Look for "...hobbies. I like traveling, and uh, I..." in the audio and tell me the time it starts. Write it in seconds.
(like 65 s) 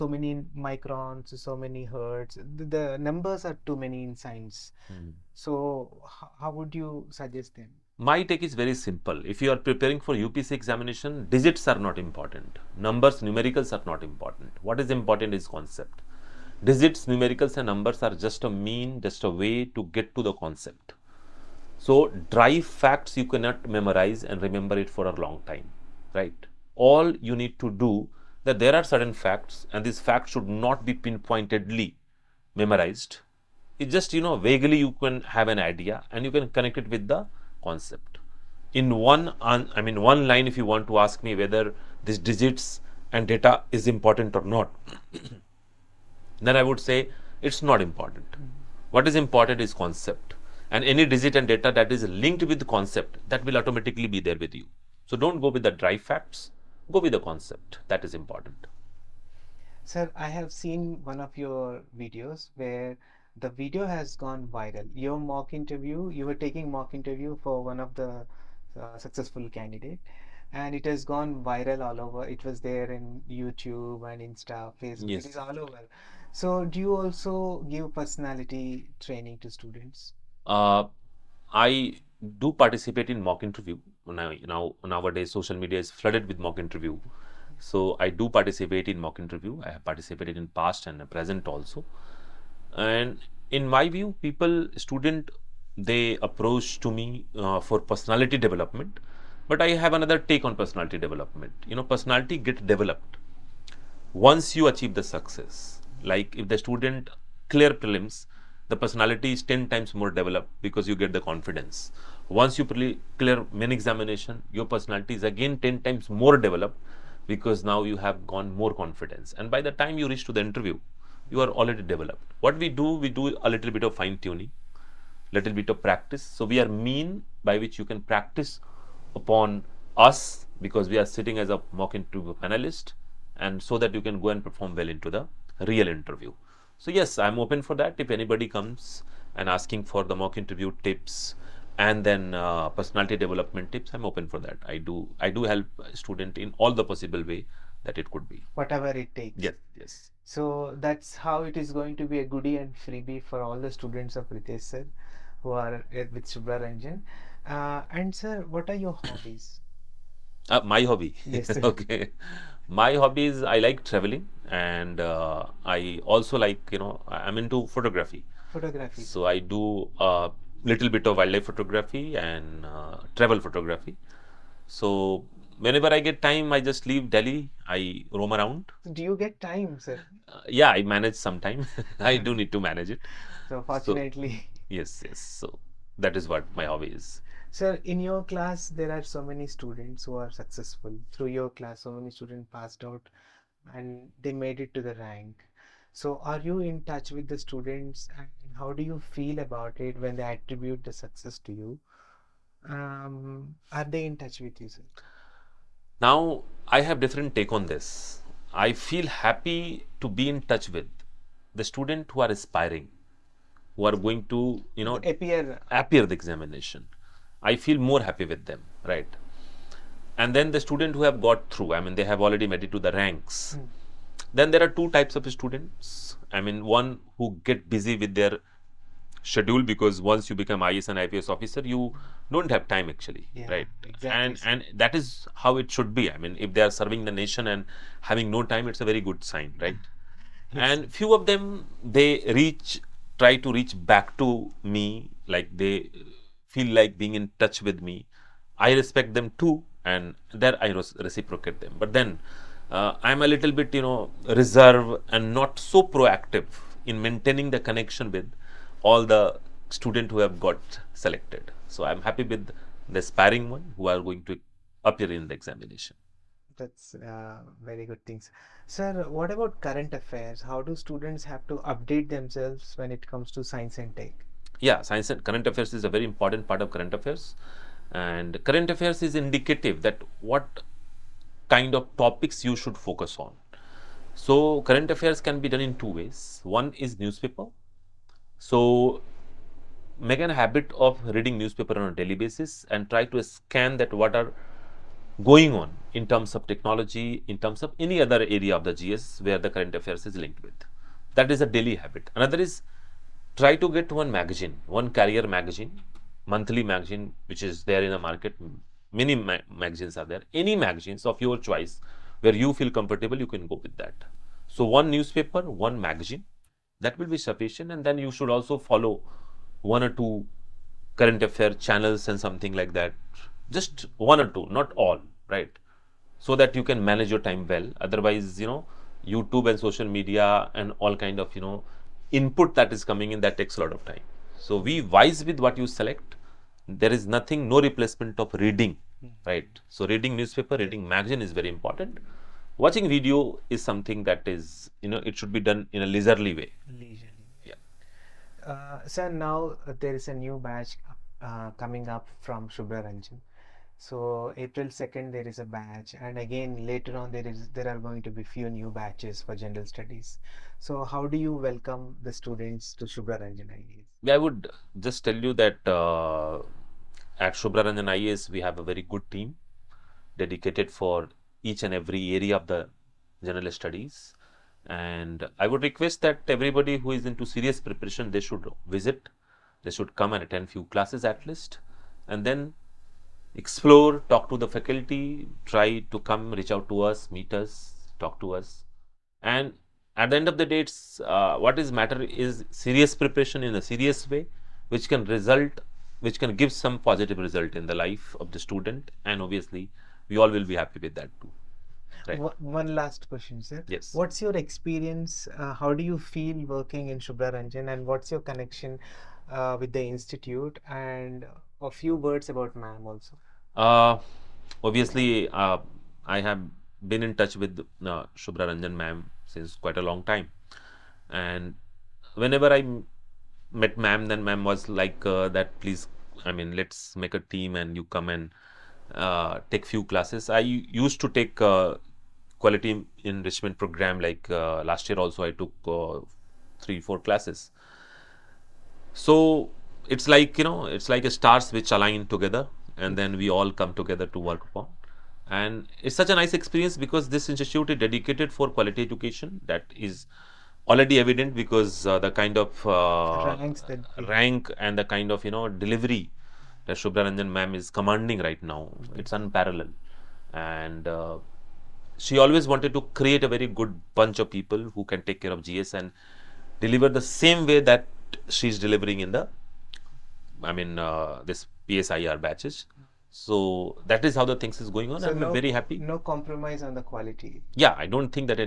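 163 s.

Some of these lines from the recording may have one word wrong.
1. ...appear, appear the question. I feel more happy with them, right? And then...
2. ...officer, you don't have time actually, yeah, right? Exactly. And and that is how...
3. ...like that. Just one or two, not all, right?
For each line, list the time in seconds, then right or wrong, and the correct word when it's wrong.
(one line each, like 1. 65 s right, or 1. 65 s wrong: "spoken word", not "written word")
1. 214 s wrong: "examination", not "question"
2. 231 s right
3. 322 s right.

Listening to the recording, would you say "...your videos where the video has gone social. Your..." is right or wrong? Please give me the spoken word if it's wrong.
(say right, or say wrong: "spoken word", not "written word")
wrong: "viral", not "social".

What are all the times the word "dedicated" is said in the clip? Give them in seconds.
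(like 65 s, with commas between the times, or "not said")
370 s, 447 s.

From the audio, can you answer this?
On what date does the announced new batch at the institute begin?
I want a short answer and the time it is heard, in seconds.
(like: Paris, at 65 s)
April 2, at 354 s.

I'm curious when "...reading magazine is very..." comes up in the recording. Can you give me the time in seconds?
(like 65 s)
340 s.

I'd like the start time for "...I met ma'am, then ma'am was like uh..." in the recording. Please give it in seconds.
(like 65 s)
422 s.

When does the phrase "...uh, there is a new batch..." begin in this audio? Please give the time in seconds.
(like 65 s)
349 s.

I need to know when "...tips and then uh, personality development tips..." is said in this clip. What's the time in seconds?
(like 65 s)
140 s.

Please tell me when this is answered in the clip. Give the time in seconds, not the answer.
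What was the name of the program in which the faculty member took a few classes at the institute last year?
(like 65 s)
432 s.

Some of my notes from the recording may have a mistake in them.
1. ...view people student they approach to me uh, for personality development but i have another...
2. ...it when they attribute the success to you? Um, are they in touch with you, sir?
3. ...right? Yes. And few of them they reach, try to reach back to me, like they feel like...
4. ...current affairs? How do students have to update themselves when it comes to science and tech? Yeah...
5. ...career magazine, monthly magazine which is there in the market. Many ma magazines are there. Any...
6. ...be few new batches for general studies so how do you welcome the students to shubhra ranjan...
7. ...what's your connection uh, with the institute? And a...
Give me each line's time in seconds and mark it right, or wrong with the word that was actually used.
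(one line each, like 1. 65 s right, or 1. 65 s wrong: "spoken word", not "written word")
1. 93 s right
2. 199 s right
3. 239 s right
4. 269 s right
5. 304 s right
6. 358 s right
7. 407 s right.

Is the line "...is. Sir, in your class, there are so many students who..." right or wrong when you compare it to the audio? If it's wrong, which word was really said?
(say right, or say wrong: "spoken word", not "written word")
right.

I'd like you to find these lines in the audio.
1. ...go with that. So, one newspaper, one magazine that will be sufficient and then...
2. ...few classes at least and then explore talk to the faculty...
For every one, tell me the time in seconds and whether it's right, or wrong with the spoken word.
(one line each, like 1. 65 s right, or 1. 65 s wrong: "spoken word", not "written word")
1. 313 s right
2. 380 s right.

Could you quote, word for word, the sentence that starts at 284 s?
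So current affairs can be done in two ways.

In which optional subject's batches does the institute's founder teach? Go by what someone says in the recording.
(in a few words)
PSIR.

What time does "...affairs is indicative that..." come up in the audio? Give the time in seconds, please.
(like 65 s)
278 s.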